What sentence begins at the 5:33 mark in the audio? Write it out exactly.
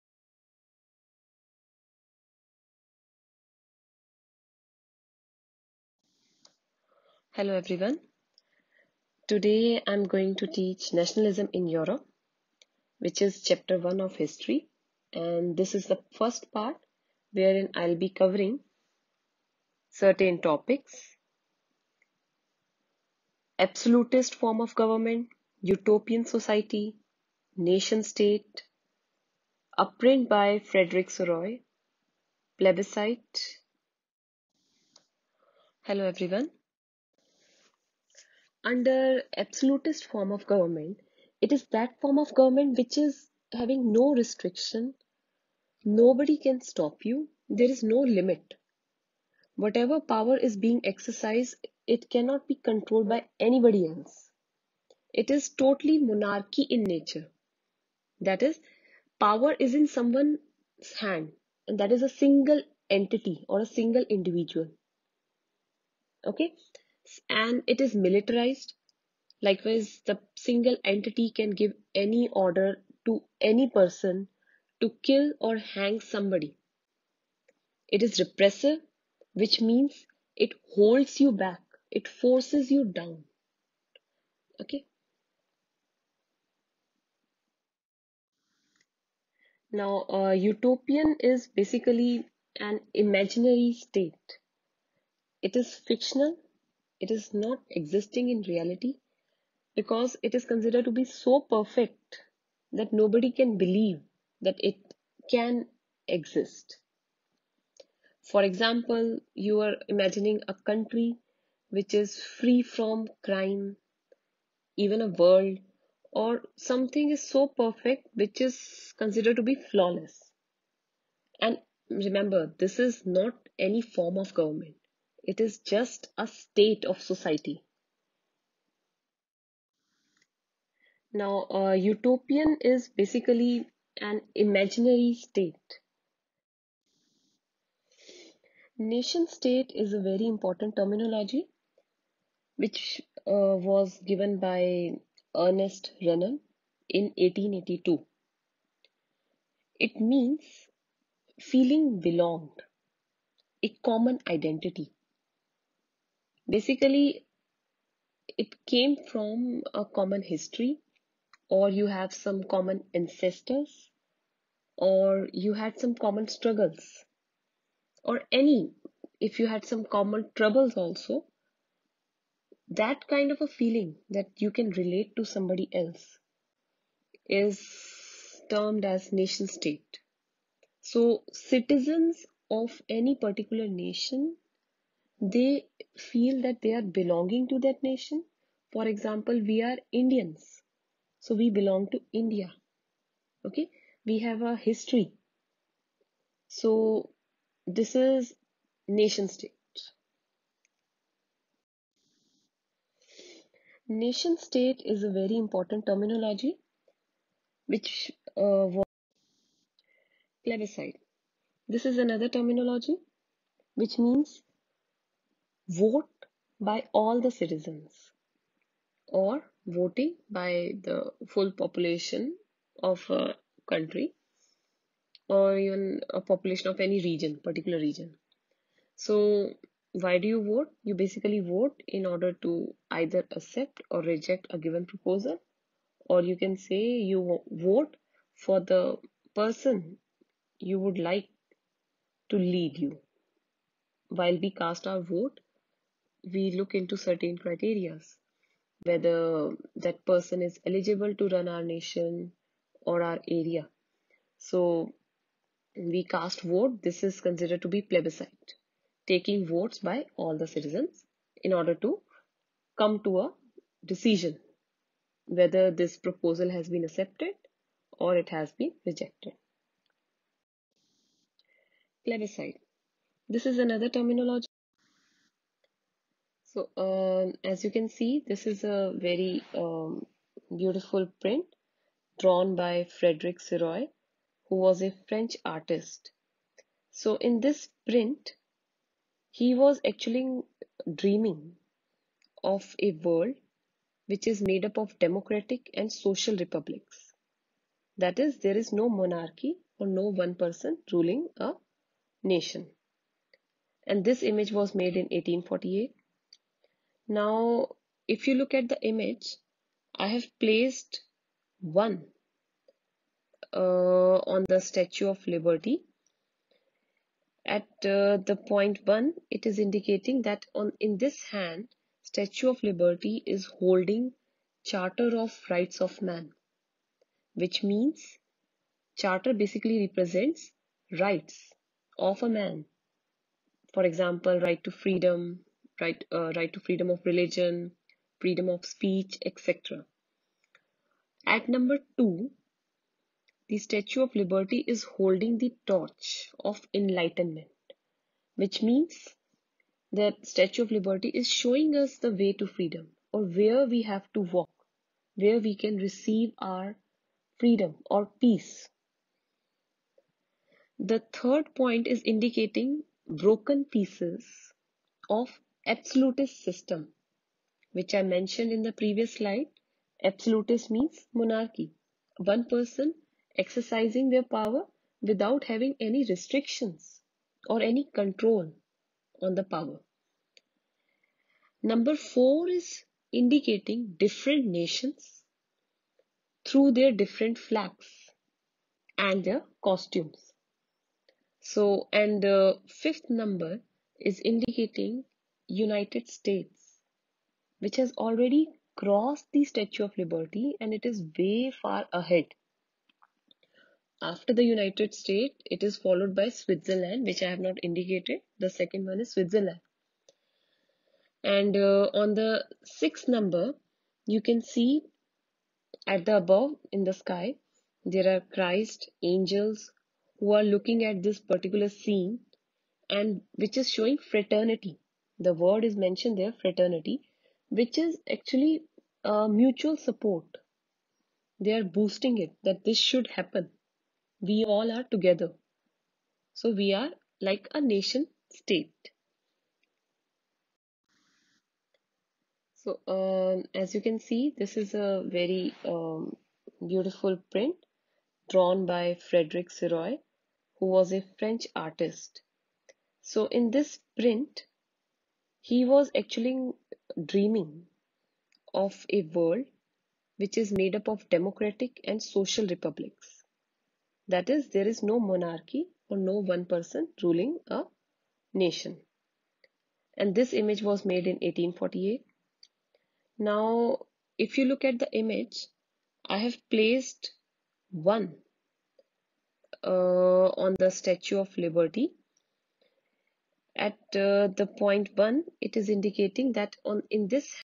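For example, right to freedom, right, uh, right to freedom of religion, freedom of speech, etc.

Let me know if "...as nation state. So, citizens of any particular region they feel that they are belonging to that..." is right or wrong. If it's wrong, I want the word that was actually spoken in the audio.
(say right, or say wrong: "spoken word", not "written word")
wrong: "nation", not "region".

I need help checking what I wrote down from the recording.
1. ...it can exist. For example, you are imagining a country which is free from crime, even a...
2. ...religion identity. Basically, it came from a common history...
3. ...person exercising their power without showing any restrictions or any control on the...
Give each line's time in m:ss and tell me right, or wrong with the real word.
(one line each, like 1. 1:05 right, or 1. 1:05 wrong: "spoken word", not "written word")
1. 1:44 right
2. 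2:33 wrong: "common", not "religion"
3. 6:12 wrong: "having", not "showing".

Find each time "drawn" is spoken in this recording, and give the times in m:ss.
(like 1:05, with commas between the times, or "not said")
4:42, 7:28.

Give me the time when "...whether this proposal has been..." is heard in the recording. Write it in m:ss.
4:25.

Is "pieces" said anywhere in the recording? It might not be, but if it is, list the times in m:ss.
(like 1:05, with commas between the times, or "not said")
6:03.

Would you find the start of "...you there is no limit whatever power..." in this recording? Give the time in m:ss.
0:47.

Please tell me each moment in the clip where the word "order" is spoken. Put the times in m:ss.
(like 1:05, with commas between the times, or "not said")
1:12, 3:52, 4:21.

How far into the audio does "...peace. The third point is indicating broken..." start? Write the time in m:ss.
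5:58.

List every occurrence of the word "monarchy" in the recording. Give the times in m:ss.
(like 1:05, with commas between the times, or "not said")
0:56, 4:58, 6:11, 7:44.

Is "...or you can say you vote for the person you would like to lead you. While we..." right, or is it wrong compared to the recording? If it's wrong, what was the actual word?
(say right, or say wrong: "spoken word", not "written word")
right.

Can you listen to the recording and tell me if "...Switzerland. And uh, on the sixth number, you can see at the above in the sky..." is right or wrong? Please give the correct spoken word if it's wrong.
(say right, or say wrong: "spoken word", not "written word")
right.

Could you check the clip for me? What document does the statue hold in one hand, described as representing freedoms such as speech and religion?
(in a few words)
Charter of Rights of Man.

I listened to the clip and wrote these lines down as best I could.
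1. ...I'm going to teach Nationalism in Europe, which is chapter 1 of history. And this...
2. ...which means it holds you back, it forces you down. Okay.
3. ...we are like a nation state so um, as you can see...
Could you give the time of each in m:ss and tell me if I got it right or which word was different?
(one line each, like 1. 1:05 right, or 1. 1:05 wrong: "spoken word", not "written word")
1. 0:09 right
2. 1:19 right
3. 7:16 right.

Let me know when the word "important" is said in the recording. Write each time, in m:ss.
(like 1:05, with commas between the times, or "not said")
2:20, 3:25.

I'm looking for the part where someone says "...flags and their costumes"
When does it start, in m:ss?
6:27.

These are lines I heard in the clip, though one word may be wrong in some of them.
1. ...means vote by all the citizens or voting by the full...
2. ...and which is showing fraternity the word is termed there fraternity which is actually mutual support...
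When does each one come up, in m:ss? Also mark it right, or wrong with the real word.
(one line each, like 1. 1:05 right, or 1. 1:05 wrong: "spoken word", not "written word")
1. 3:33 right
2. 7:02 wrong: "mentioned", not "termed".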